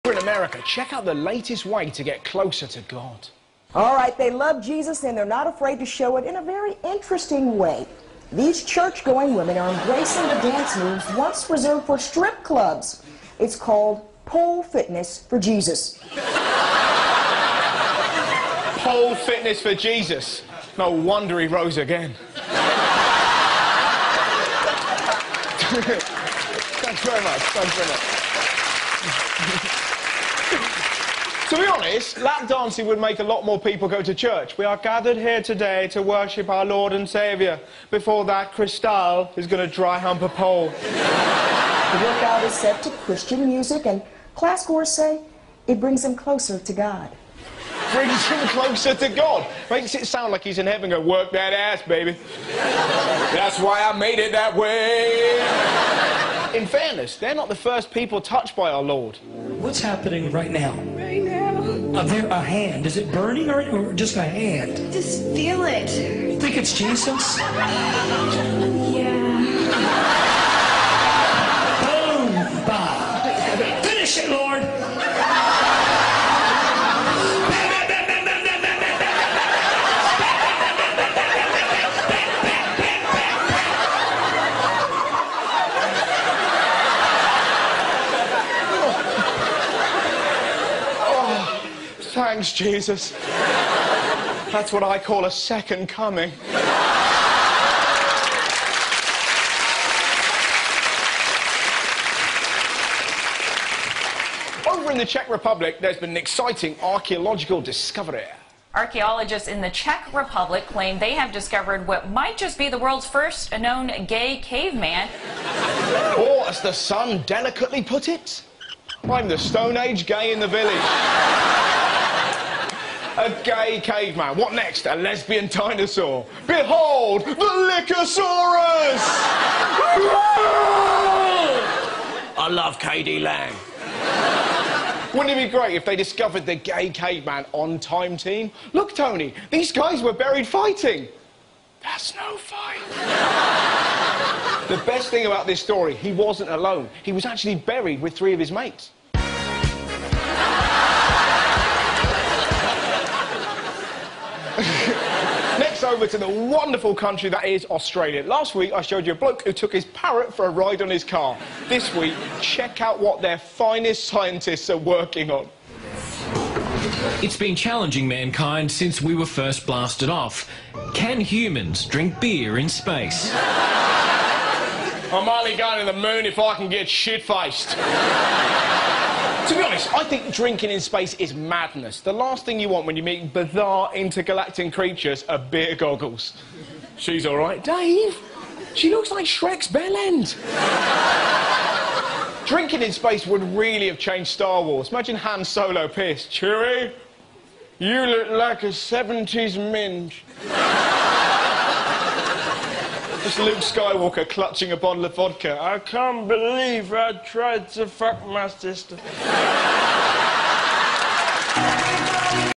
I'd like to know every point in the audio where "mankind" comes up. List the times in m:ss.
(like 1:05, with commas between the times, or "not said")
2:48.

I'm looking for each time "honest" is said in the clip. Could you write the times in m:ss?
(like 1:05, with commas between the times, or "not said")
0:31, 2:59.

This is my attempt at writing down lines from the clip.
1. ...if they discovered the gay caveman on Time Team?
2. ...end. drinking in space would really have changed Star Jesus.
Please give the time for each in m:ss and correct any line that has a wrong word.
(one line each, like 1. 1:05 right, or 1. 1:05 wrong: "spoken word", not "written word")
1. 2:15 right
2. 3:09 wrong: "Wars", not "Jesus".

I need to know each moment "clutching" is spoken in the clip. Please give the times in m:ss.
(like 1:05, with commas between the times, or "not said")
3:24.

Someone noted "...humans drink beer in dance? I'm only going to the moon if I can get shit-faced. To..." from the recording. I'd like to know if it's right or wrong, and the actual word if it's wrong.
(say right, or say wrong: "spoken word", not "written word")
wrong: "space", not "dance".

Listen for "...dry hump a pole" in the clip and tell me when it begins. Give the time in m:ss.
0:39.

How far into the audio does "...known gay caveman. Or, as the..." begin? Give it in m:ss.
1:53.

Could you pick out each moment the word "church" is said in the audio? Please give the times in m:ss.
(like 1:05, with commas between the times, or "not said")
0:08, 0:34.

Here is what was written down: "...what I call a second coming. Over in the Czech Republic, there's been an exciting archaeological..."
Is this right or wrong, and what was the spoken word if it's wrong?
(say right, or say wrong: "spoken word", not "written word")
right.